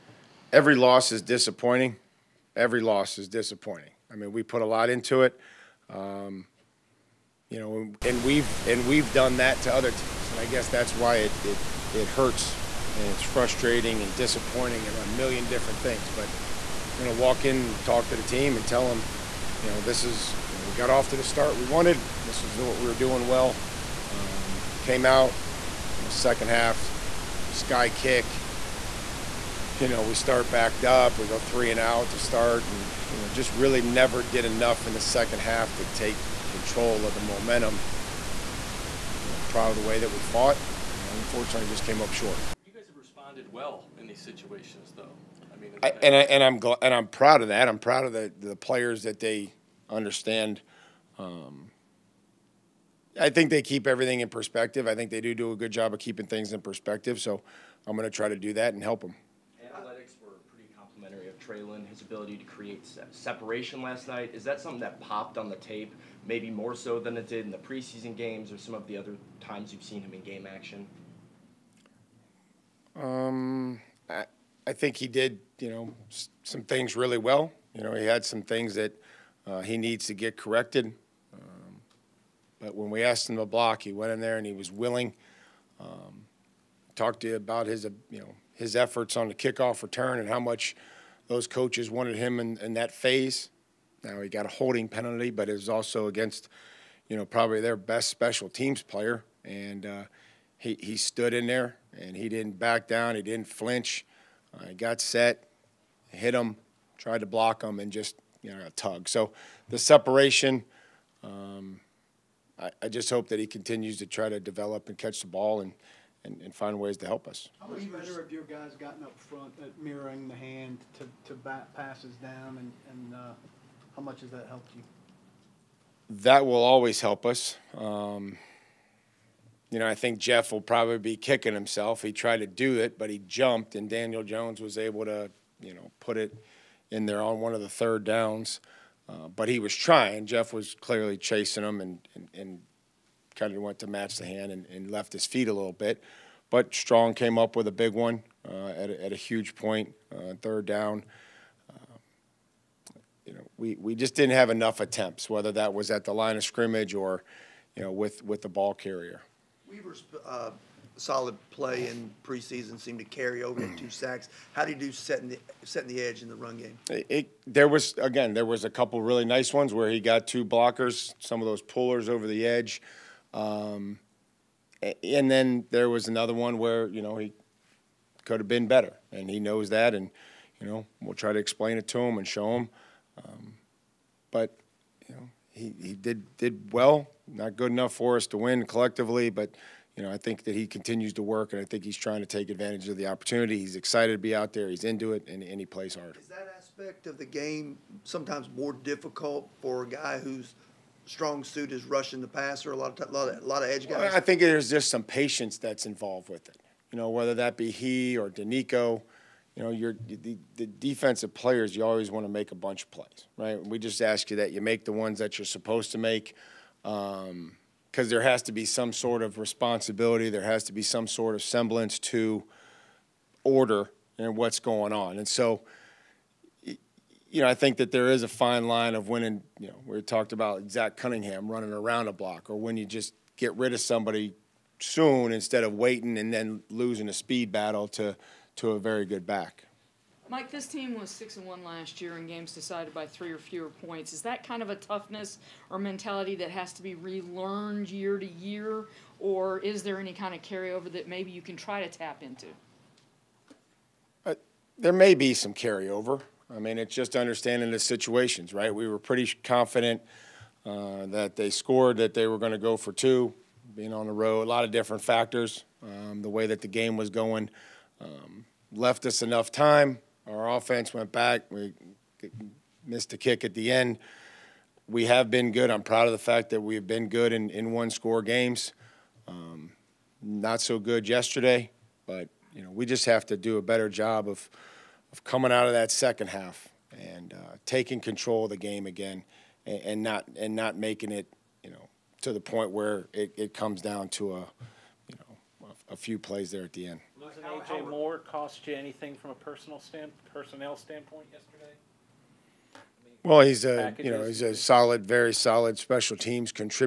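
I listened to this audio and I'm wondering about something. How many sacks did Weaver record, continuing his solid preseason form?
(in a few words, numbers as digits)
2.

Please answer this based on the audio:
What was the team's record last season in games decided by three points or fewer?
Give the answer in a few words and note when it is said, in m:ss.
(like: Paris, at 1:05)
6 and 1, at 4:01.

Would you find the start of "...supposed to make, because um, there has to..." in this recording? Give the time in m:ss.
3:35.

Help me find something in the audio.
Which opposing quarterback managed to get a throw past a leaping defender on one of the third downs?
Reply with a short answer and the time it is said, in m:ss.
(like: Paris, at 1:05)
Daniel Jones, at 2:13.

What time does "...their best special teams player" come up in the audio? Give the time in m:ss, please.
1:37.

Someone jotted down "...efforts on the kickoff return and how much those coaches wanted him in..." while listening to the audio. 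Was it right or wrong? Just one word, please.
right.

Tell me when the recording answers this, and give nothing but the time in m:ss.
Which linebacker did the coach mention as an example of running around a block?
3:50.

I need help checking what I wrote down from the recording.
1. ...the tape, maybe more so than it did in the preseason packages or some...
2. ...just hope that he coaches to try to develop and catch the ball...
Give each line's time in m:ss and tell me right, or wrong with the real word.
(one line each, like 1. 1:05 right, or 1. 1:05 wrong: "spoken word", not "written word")
1. 1:05 wrong: "games", not "packages"
2. 1:52 wrong: "continues", not "coaches".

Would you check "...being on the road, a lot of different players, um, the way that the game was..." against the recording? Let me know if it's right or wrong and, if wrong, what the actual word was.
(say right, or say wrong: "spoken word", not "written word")
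wrong: "factors", not "players".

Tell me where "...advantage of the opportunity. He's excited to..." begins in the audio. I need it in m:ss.
3:12.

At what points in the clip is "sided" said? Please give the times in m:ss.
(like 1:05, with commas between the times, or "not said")
not said.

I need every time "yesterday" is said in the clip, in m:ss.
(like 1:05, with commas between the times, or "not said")
4:41, 5:01.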